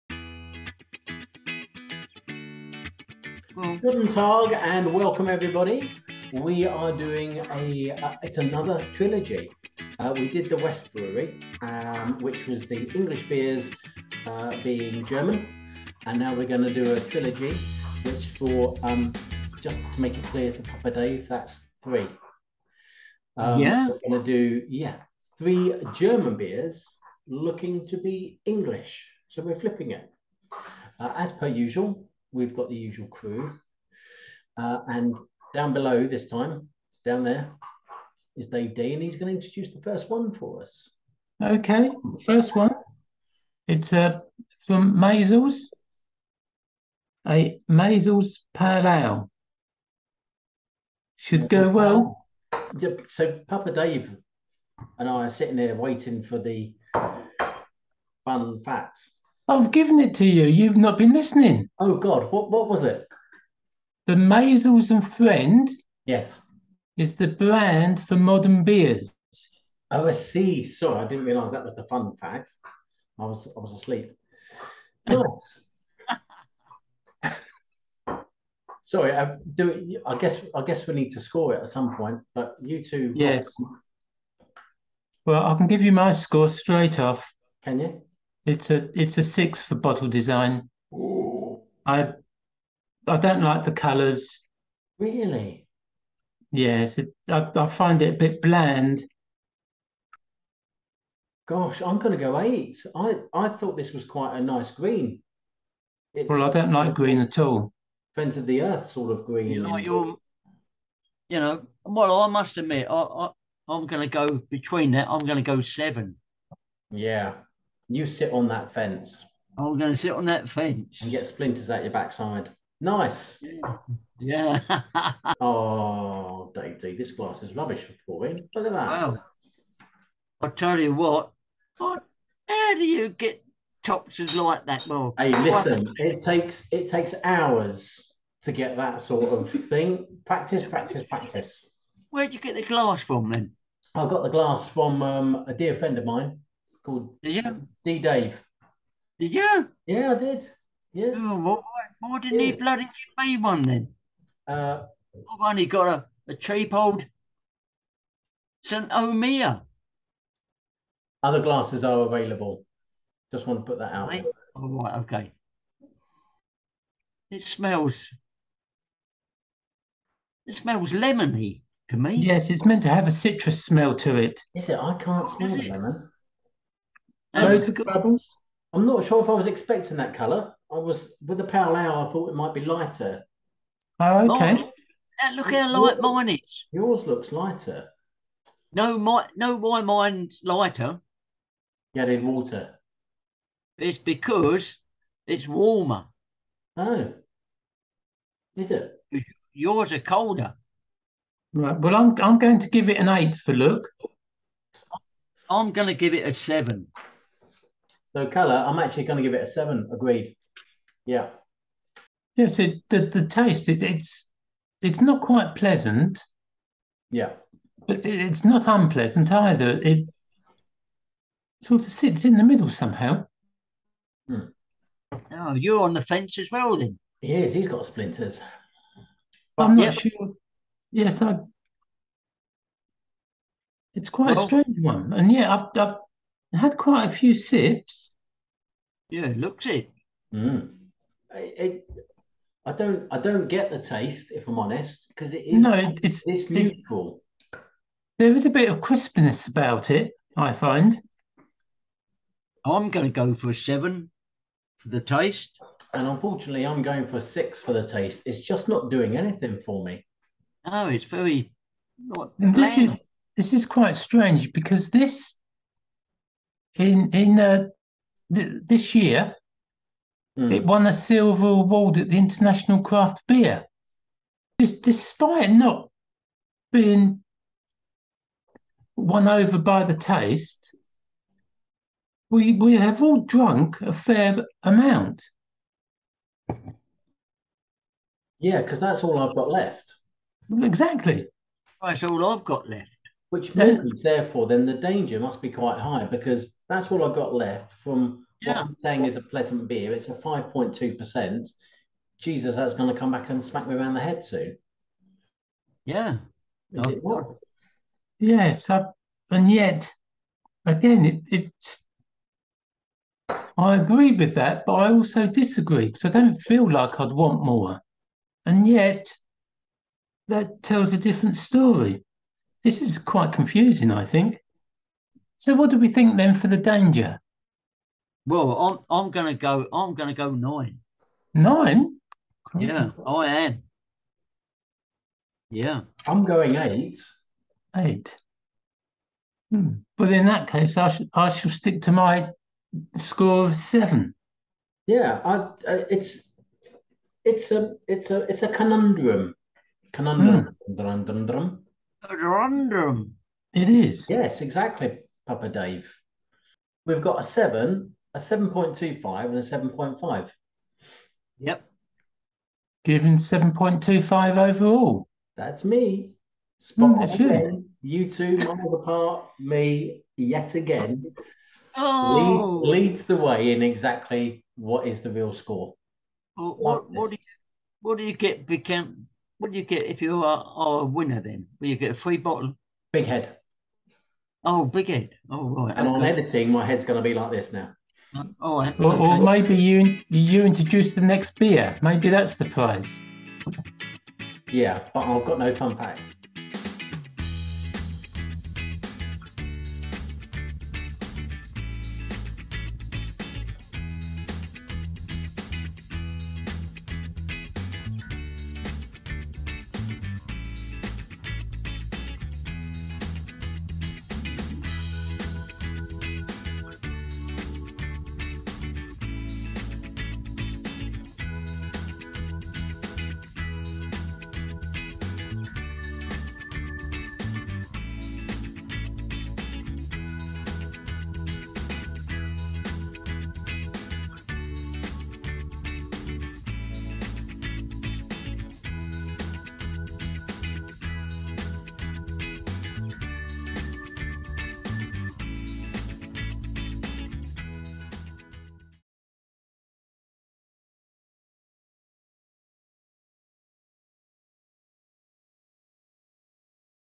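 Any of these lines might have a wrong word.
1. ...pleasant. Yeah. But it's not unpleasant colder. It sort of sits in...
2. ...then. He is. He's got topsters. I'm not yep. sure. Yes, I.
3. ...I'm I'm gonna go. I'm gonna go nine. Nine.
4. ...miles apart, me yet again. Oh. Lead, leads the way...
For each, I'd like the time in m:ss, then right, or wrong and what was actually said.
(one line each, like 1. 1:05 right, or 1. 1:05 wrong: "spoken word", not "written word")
1. 3:35 wrong: "either", not "colder"
2. 3:46 wrong: "splinters", not "topsters"
3. 5:28 right
4. 6:08 right.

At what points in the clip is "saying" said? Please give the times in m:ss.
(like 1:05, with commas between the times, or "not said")
4:58.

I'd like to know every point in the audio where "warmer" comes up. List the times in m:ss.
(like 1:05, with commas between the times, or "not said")
3:15.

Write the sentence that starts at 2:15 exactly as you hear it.
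Hey, listen, it takes it takes hours to get that sort of thing.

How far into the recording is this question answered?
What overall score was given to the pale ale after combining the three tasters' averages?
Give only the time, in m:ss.
6:03.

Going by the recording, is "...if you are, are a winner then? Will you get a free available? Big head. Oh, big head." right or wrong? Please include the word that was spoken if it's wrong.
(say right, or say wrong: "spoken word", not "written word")
wrong: "bottle", not "available".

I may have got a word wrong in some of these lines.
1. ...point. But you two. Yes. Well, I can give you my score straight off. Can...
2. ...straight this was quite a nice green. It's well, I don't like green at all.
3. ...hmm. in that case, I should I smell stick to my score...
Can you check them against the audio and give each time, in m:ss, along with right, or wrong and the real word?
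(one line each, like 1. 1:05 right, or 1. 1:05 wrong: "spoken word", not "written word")
1. 1:21 right
2. 1:43 wrong: "thought", not "straight"
3. 5:40 wrong: "shall", not "smell".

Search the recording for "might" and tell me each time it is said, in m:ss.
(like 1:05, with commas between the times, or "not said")
3:02.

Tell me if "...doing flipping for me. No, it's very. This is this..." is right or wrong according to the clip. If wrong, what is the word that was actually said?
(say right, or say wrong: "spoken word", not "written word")
wrong: "anything", not "flipping".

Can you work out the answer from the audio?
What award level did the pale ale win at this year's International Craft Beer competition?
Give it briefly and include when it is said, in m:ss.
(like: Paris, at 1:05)
Silver, at 4:30.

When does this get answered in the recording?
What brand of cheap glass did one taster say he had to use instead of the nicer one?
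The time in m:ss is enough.
2:38.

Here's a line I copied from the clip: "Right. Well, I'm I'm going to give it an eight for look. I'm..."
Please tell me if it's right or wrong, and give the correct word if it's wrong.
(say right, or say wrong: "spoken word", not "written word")
right.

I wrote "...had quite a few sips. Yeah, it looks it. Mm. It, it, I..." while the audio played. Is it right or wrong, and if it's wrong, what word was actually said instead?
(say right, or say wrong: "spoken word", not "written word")
right.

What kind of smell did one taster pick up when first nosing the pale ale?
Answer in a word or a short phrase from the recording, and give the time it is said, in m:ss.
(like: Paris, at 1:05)
Lemony, at 2:50.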